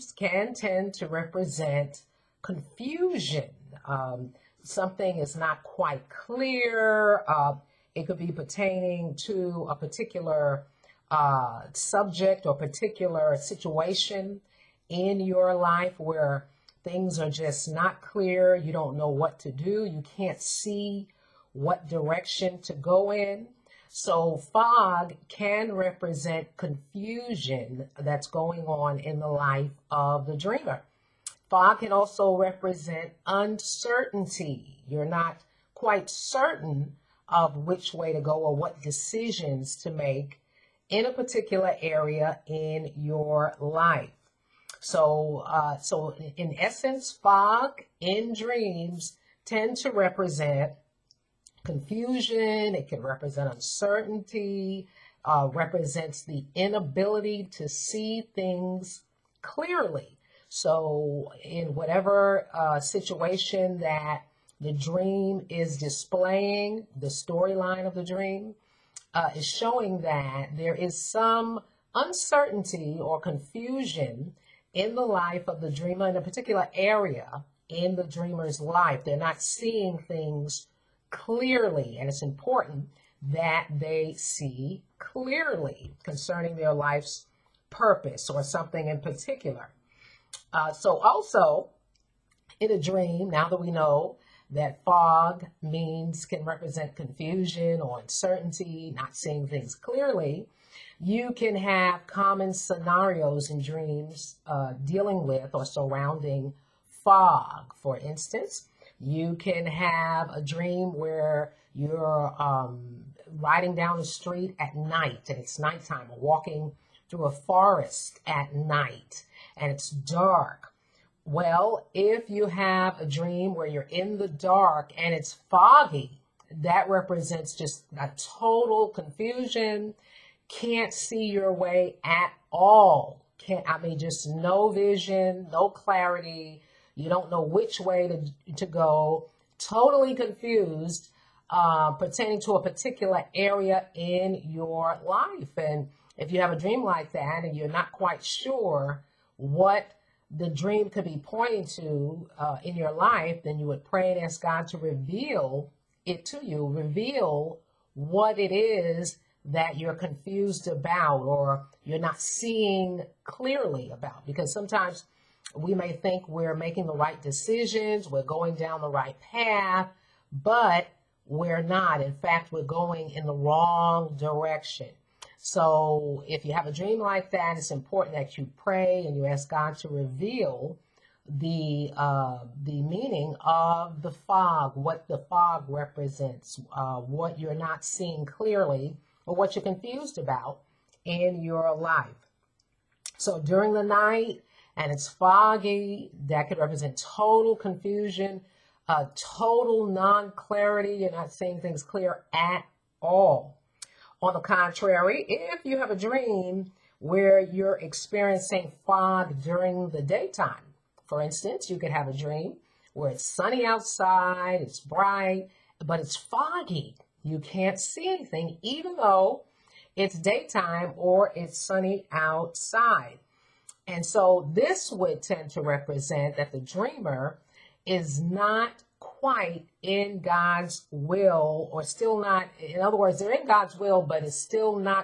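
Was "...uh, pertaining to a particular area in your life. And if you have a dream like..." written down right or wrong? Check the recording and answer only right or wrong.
right.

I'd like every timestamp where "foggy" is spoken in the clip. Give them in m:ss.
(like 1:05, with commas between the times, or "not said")
2:05, 3:15, 3:36.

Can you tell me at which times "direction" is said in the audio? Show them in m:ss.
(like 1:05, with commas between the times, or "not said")
0:21, 2:54.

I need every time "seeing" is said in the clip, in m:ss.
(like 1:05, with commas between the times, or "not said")
1:19, 1:39, 2:42, 3:07, 3:21.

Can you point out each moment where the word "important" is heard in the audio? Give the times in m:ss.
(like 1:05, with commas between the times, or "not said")
1:22, 2:57.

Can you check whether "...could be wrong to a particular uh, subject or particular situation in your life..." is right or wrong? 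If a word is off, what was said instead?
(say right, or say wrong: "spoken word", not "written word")
wrong: "pertaining", not "wrong".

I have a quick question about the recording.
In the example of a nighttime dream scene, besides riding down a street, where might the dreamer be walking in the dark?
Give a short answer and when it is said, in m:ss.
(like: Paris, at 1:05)
Through a forest, at 1:56.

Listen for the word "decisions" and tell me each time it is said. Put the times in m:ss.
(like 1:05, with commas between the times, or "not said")
0:38, 2:47.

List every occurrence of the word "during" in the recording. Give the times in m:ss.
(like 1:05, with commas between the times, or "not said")
3:13, 3:29.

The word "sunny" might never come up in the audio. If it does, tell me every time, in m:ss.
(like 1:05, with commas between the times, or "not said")
3:33, 3:41.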